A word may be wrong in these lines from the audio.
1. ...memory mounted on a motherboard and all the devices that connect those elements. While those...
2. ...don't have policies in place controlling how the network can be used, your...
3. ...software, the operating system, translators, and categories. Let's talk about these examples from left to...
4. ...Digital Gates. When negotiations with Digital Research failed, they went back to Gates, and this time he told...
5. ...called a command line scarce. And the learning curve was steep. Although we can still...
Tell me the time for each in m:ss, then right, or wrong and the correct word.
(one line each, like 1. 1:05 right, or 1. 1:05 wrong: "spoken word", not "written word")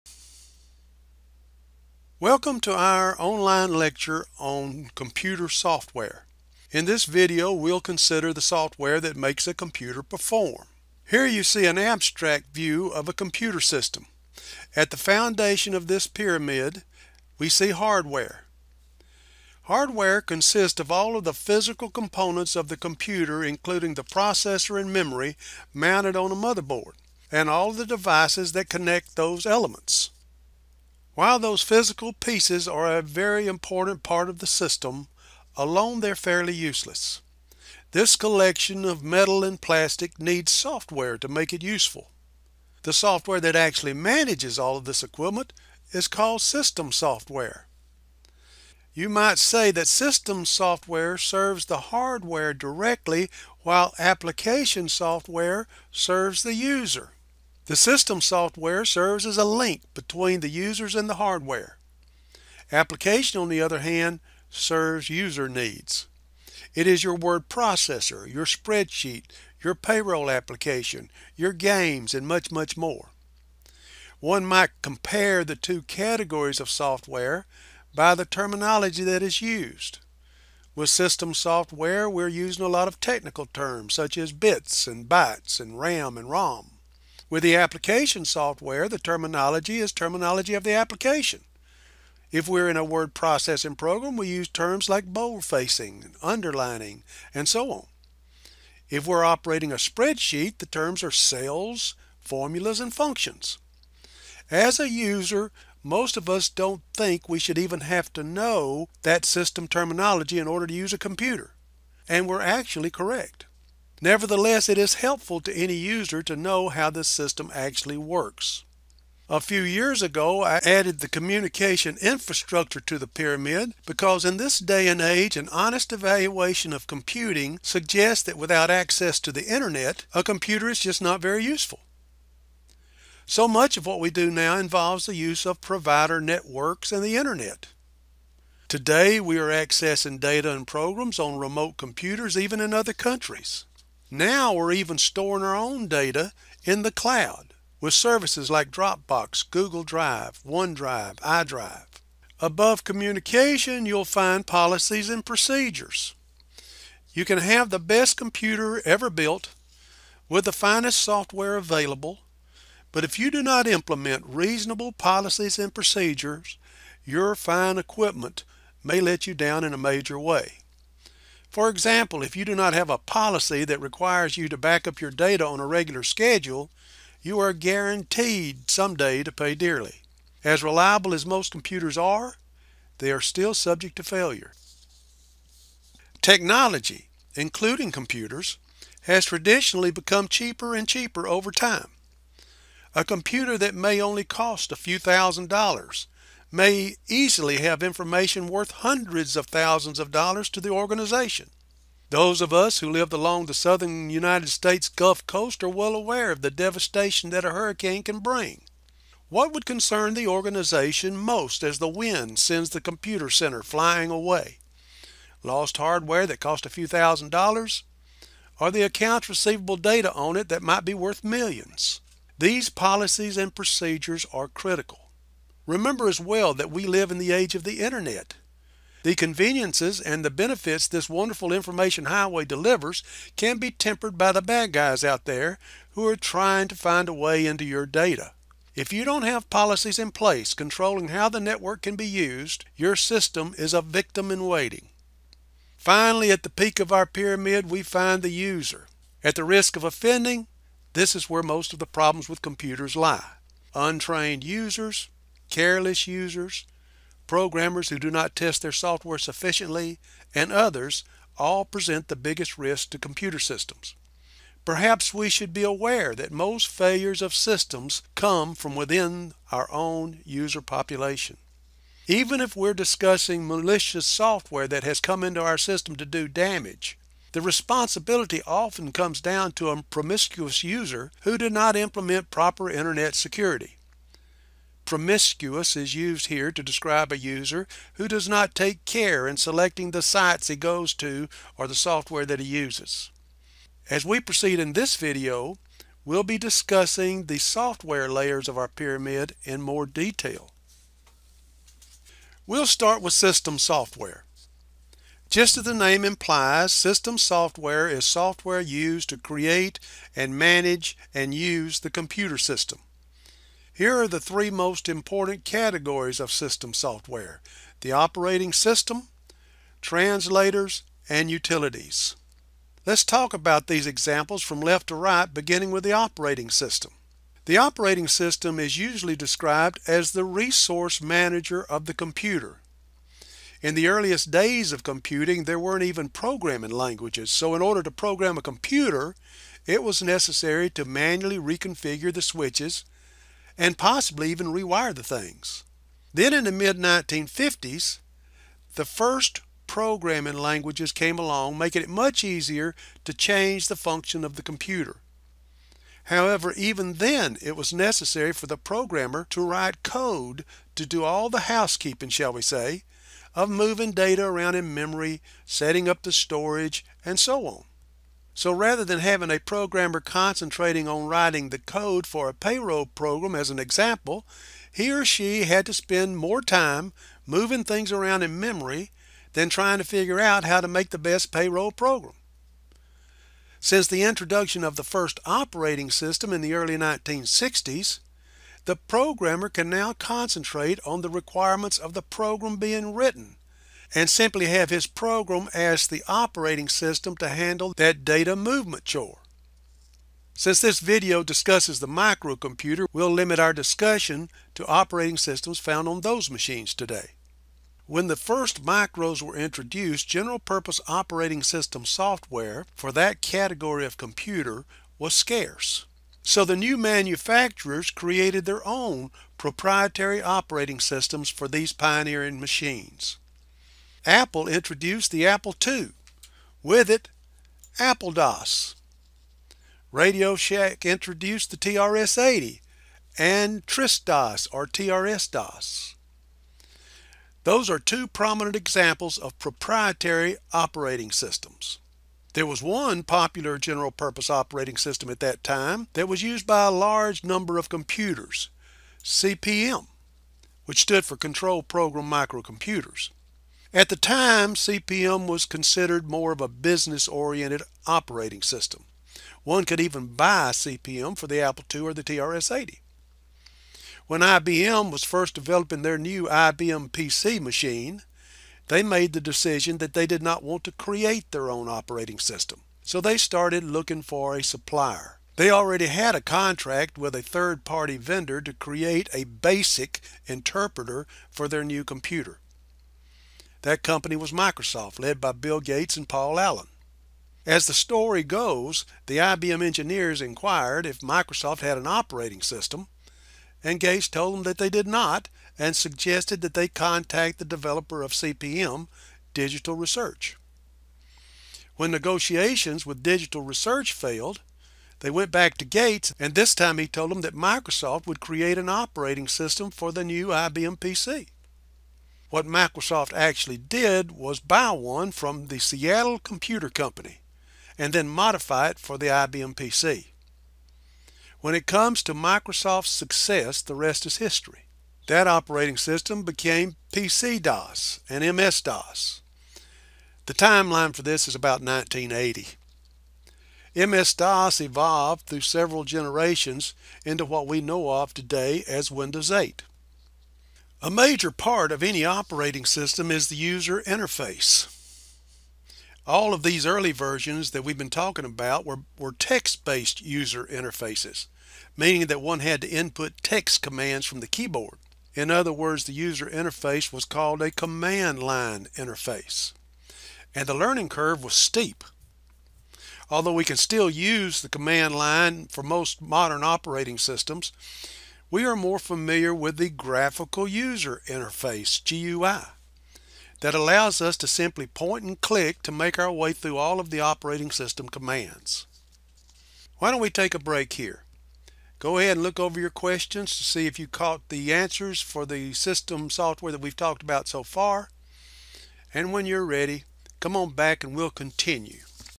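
1. 0:24 right
2. 3:59 right
3. 5:16 wrong: "utilities", not "categories"
4. 8:19 wrong: "Research", not "Gates"
5. 9:17 wrong: "interface", not "scarce".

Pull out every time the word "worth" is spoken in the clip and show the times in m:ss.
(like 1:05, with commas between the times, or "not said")
3:18, 3:40.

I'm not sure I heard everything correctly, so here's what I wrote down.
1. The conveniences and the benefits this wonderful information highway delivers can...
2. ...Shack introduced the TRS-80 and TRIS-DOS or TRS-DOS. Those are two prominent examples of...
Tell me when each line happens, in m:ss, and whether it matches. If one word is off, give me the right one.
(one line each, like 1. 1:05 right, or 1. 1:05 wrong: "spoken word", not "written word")
1. 3:49 right
2. 7:10 right.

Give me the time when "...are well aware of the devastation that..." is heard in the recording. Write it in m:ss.
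3:25.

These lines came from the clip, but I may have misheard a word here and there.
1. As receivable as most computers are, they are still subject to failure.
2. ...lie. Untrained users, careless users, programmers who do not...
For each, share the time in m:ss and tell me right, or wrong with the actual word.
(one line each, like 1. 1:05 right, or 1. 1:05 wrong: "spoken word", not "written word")
1. 3:00 wrong: "reliable", not "receivable"
2. 4:12 right.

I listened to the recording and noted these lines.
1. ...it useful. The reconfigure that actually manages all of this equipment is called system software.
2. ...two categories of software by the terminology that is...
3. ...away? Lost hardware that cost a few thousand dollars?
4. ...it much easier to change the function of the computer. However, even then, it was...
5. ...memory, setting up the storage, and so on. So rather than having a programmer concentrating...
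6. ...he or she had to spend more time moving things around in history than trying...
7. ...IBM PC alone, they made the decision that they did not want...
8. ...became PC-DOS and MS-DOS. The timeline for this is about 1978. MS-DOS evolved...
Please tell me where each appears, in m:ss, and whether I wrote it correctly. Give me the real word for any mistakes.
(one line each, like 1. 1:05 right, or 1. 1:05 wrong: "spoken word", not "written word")
1. 0:41 wrong: "software", not "reconfigure"
2. 1:15 right
3. 3:34 right
4. 5:51 right
5. 6:04 right
6. 6:14 wrong: "memory", not "history"
7. 7:46 wrong: "machine", not "alone"
8. 8:46 wrong: "1980", not "1978".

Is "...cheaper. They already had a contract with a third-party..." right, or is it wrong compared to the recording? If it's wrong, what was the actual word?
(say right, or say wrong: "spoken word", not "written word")
wrong: "supplier", not "cheaper".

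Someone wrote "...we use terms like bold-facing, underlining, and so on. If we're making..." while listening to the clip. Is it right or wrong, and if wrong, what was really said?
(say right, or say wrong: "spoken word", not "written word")
wrong: "operating", not "making".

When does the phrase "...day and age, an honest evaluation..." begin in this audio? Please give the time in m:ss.
2:04.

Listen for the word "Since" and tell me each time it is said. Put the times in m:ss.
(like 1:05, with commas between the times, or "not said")
6:23, 6:40.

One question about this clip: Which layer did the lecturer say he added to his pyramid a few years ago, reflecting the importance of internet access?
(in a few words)
Communication infrastructure.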